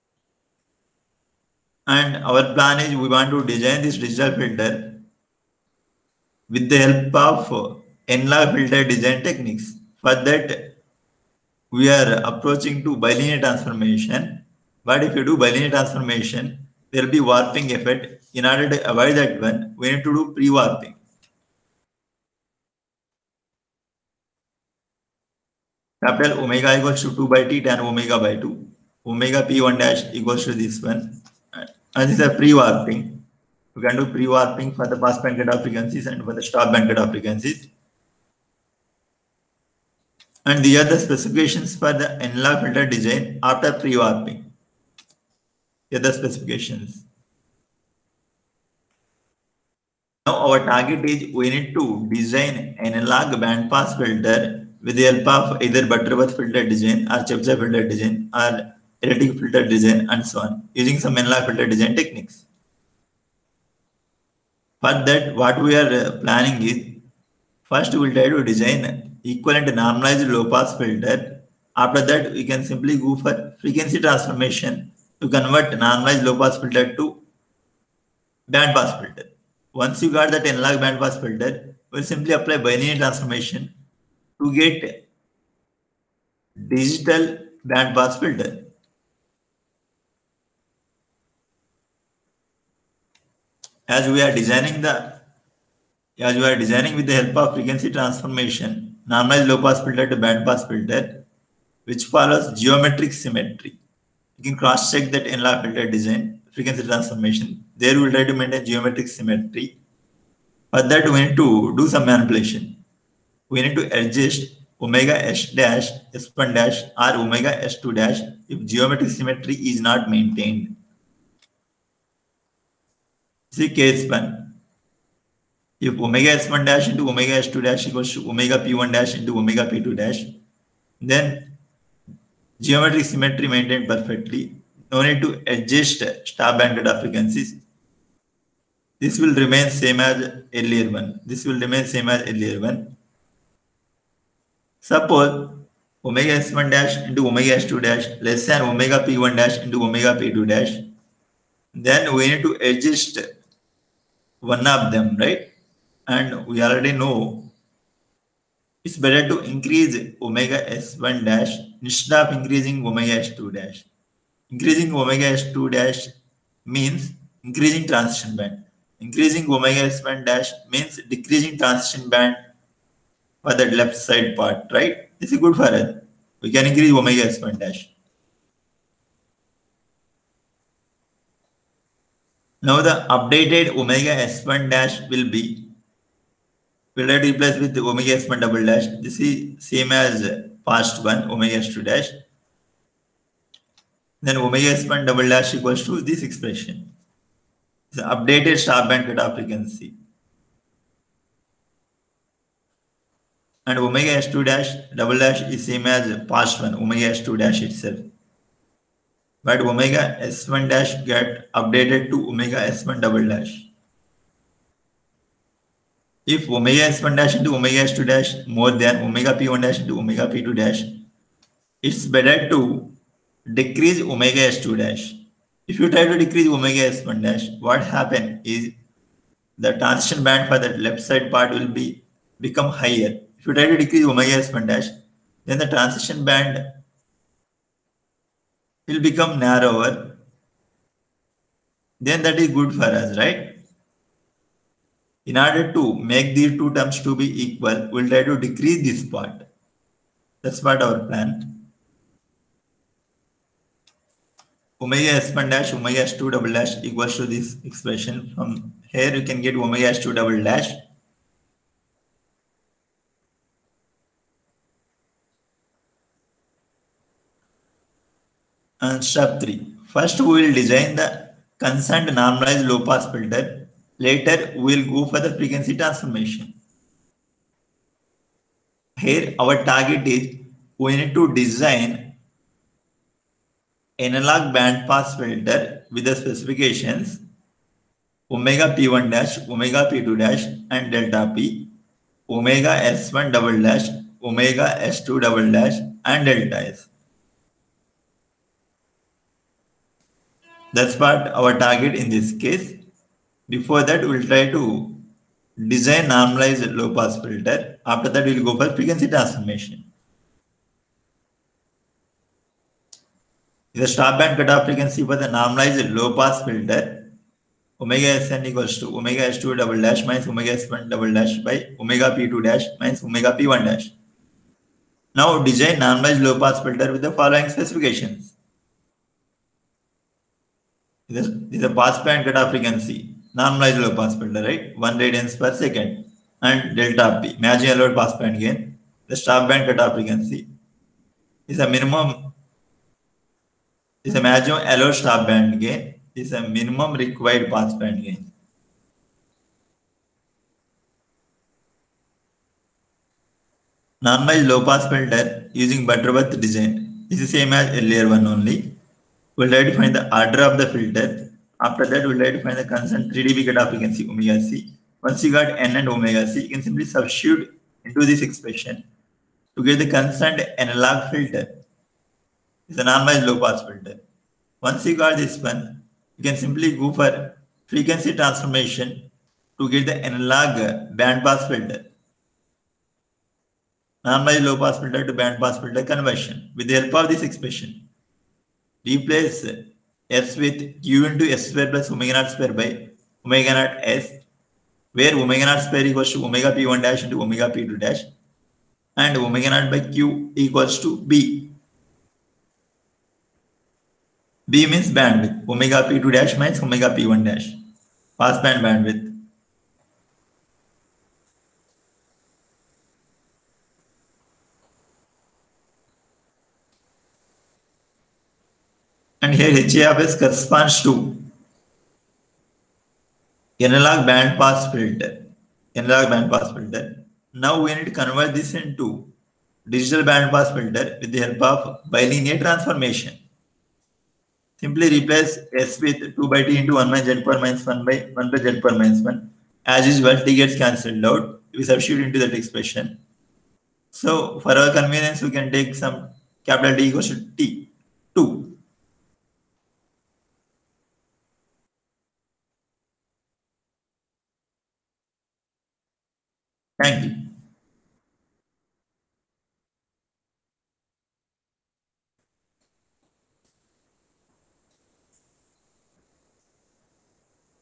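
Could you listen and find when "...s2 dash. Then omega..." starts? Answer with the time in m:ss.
3:11.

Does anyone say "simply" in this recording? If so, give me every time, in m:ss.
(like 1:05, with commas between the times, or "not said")
1:12, 1:22, 6:06, 6:16, 7:14.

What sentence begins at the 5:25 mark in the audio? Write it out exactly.
Now design normalized low pass filter with the following specifications.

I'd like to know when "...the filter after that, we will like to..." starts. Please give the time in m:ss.
6:00.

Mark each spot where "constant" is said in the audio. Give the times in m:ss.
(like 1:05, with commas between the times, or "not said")
6:02, 6:09.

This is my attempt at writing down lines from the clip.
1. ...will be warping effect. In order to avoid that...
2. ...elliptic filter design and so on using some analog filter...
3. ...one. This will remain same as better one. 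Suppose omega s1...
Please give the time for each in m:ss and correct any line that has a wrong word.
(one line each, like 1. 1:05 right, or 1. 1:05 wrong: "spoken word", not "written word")
1. 0:17 right
2. 0:59 right
3. 2:20 wrong: "earlier", not "better".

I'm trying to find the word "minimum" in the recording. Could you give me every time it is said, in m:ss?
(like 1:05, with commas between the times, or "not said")
5:41, 5:46.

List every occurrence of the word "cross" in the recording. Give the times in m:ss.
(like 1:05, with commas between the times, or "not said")
1:44.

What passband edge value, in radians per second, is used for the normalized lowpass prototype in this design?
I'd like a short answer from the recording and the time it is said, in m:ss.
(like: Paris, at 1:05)
1 radian per second, at 5:34.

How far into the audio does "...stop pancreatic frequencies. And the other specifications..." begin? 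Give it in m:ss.
0:36.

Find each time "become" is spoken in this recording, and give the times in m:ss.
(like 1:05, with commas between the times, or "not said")
3:52, 3:59.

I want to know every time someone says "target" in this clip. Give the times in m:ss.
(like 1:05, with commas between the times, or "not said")
0:50, 4:39, 5:01.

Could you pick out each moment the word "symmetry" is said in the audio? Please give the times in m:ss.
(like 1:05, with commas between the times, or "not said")
1:43, 1:49, 1:59, 2:13.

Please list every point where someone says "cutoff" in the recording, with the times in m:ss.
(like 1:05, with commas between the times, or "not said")
3:19, 5:14, 5:32, 5:39.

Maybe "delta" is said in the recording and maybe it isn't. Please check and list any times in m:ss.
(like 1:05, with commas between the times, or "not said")
4:50, 4:56, 5:36.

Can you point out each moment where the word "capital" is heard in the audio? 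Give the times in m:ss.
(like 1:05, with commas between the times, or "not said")
0:26, 7:26.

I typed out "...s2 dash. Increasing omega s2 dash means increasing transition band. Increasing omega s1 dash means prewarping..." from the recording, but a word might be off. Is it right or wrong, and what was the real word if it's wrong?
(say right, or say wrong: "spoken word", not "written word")
wrong: "decreasing", not "prewarping".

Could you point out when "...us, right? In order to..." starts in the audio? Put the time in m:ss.
4:02.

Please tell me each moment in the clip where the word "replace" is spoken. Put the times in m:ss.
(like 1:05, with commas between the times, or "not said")
3:07, 6:28, 7:14.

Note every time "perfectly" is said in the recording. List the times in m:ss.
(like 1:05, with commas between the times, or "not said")
2:13.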